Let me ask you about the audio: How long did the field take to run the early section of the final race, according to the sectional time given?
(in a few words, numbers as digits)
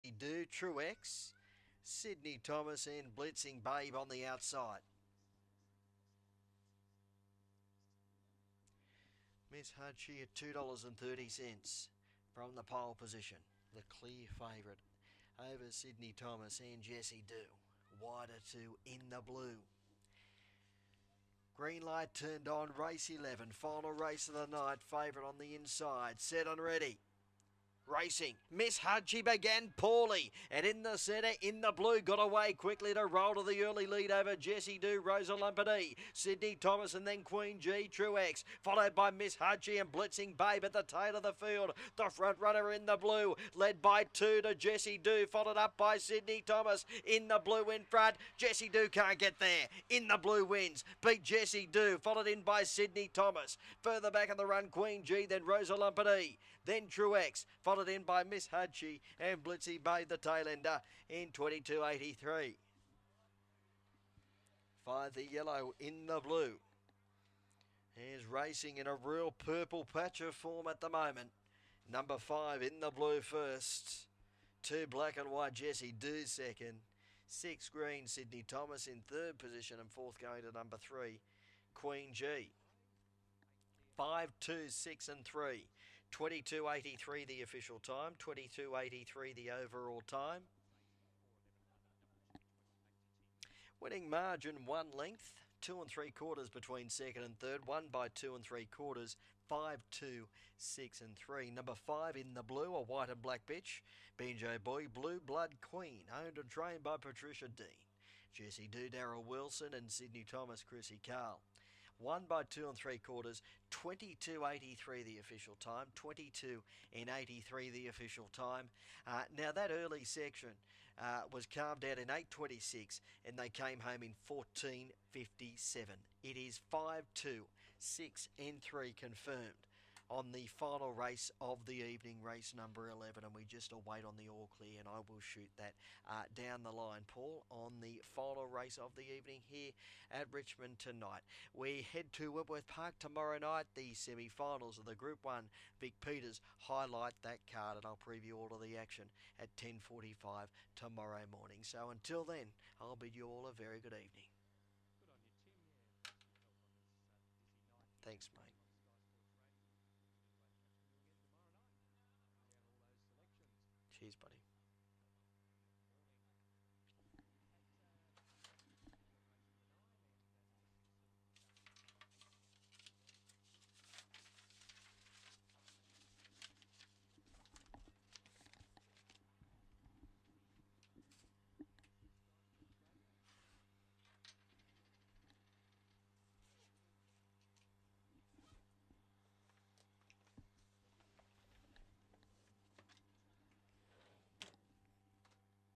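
8.26.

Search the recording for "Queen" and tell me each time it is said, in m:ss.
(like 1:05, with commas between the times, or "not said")
0:37, 0:54, 1:21, 1:45.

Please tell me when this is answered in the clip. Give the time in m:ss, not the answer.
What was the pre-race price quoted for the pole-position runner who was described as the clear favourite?
0:10.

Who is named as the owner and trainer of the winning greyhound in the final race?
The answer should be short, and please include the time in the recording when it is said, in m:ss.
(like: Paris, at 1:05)
Patricia Dean, at 1:47.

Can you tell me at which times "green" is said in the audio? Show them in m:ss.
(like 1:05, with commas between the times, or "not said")
0:21, 1:17.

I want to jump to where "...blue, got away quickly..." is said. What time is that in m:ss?
0:31.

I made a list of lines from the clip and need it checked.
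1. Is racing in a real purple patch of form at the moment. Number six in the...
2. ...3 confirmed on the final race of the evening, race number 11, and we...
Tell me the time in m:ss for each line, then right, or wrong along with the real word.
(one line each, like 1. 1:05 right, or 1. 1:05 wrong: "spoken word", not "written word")
1. 1:07 wrong: "five", not "six"
2. 2:08 right.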